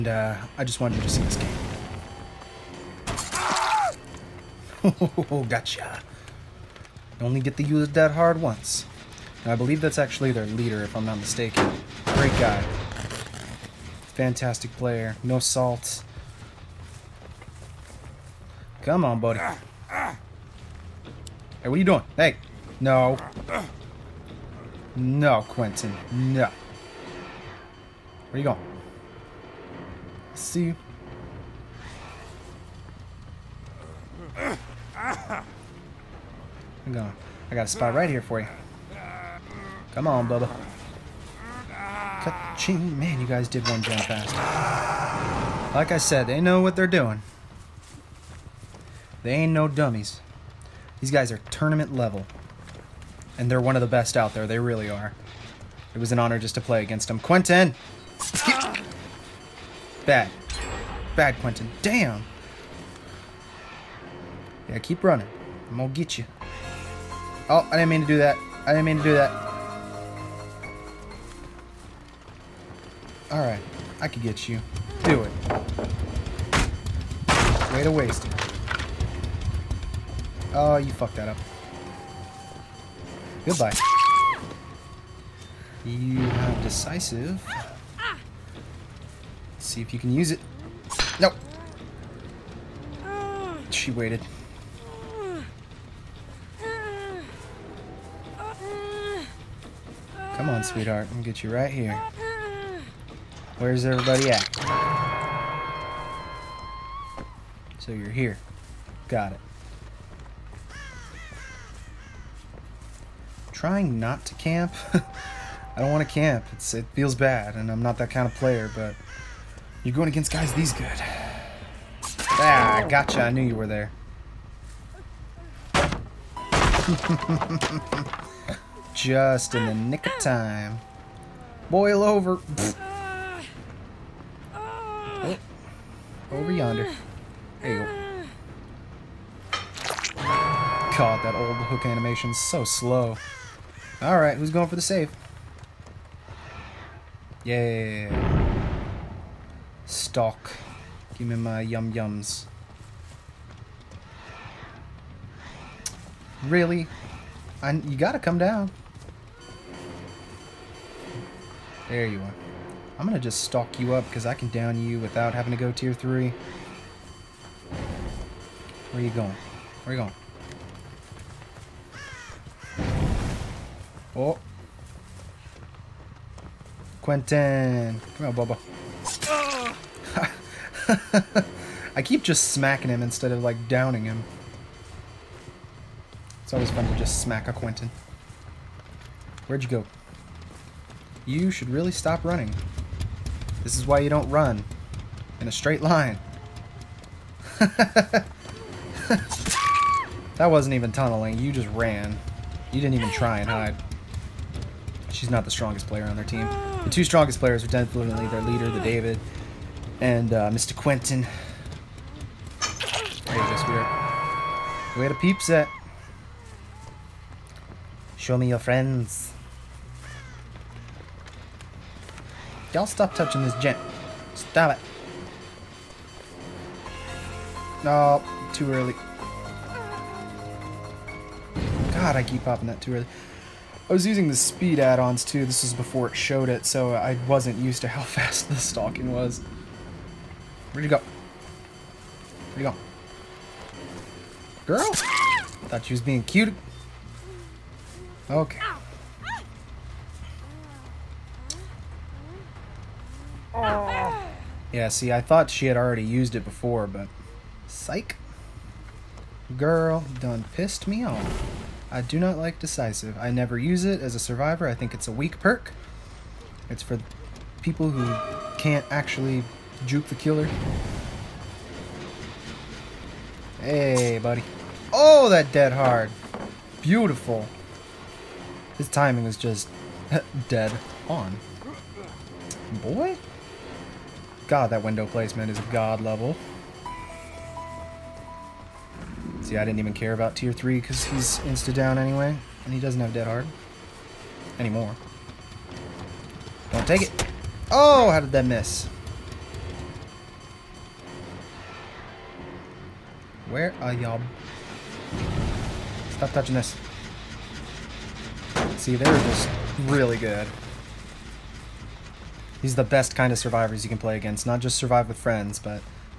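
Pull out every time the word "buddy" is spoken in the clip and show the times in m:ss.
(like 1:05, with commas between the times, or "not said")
0:19, 4:34.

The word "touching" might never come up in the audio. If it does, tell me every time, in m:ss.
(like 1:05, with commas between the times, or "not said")
3:43, 5:06.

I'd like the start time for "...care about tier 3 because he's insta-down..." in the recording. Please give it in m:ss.
4:49.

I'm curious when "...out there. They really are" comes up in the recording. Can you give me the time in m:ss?
0:54.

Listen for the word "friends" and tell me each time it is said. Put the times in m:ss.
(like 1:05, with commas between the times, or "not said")
3:38, 5:15.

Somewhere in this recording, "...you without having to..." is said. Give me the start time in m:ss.
2:44.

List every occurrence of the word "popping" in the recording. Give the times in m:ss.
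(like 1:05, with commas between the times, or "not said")
3:52.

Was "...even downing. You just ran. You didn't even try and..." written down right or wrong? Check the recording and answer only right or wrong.
wrong.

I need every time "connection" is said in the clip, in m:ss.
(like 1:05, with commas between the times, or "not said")
not said.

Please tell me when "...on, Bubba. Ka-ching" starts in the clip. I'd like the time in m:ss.
0:40.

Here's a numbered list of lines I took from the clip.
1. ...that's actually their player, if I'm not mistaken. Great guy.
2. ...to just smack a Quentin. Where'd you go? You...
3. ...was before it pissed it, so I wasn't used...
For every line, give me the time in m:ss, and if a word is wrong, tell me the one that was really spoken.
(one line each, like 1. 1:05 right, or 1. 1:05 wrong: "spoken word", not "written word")
1. 0:09 wrong: "leader", not "player"
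2. 3:06 right
3. 3:55 wrong: "showed", not "pissed".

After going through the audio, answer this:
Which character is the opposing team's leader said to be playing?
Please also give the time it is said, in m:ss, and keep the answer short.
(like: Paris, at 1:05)
David, at 3:28.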